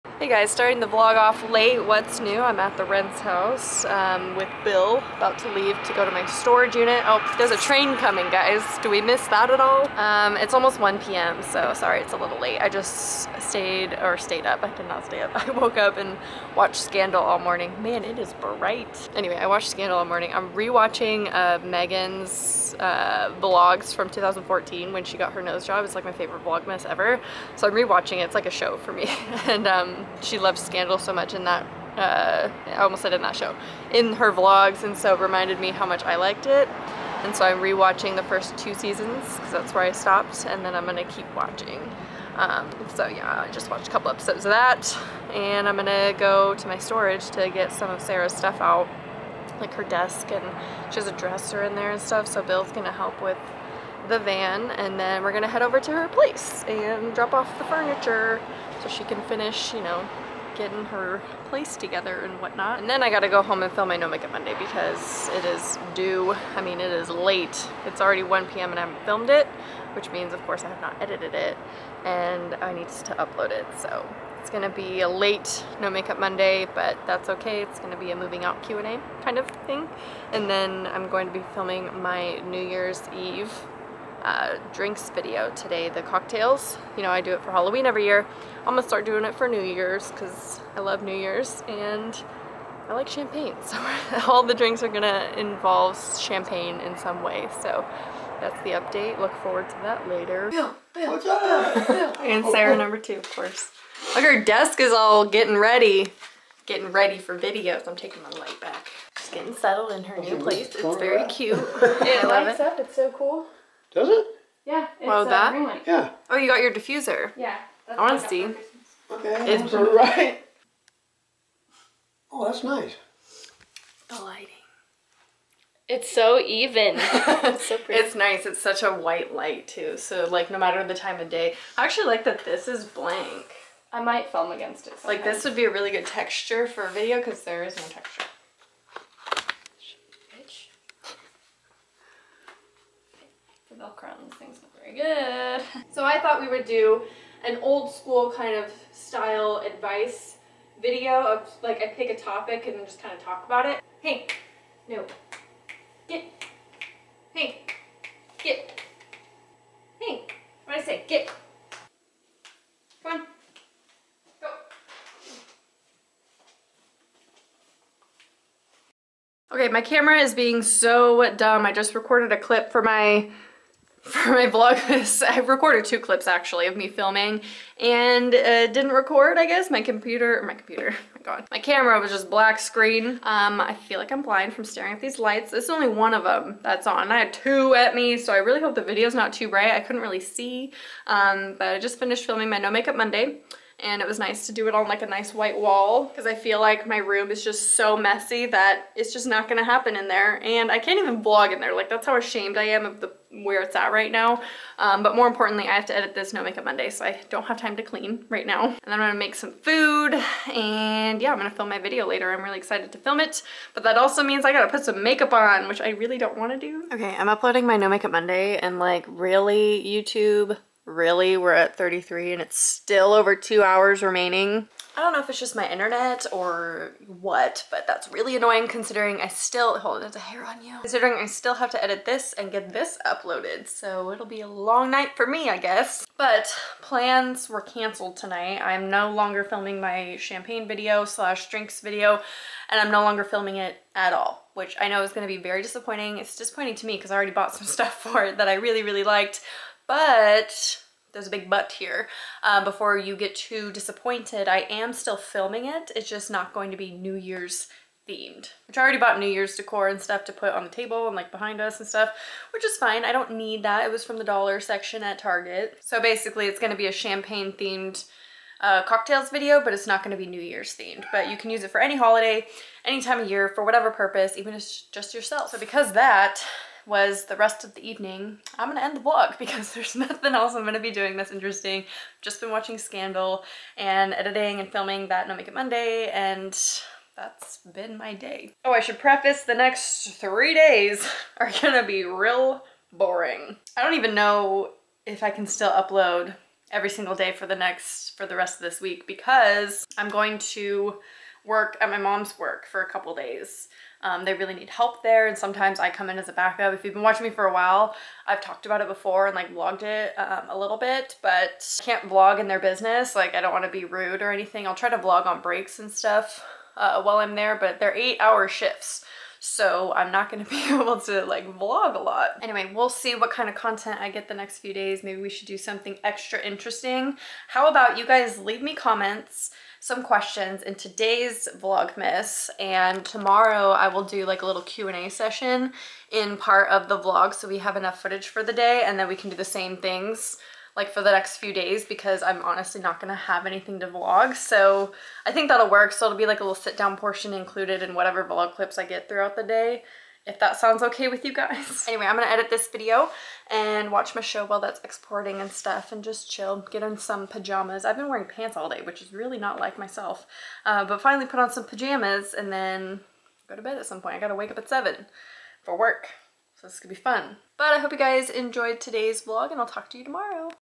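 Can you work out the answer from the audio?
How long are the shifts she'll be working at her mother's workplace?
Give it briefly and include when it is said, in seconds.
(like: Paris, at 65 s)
8 hours, at 317 s.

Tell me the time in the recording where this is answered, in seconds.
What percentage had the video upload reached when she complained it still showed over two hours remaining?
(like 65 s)
221 s.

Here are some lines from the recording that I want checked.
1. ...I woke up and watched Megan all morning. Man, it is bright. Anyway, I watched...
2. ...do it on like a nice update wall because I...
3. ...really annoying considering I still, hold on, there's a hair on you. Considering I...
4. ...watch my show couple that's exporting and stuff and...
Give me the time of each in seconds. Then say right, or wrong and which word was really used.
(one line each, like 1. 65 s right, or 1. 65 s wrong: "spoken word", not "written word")
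1. 15 s wrong: "Scandal", not "Megan"
2. 194 s wrong: "white", not "update"
3. 228 s right
4. 353 s wrong: "while", not "couple".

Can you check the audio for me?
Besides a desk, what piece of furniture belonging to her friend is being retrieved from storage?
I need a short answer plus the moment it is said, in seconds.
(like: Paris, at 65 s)
Dresser, at 51 s.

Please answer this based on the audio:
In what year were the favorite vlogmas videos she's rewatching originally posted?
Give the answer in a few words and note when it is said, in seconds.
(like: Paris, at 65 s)
2014, at 24 s.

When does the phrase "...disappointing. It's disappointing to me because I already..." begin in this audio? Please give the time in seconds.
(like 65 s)
245 s.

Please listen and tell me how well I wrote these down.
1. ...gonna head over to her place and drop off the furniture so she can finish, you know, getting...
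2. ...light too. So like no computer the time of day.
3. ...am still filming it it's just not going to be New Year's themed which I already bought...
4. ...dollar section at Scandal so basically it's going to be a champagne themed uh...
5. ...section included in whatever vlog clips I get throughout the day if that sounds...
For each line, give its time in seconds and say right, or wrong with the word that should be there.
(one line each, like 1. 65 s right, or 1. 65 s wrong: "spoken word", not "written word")
1. 55 s right
2. 129 s wrong: "matter", not "computer"
3. 254 s right
4. 264 s wrong: "Target", not "Scandal"
5. 346 s wrong: "portion", not "section".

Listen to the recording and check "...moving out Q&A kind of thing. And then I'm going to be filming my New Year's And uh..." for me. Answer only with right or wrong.
wrong.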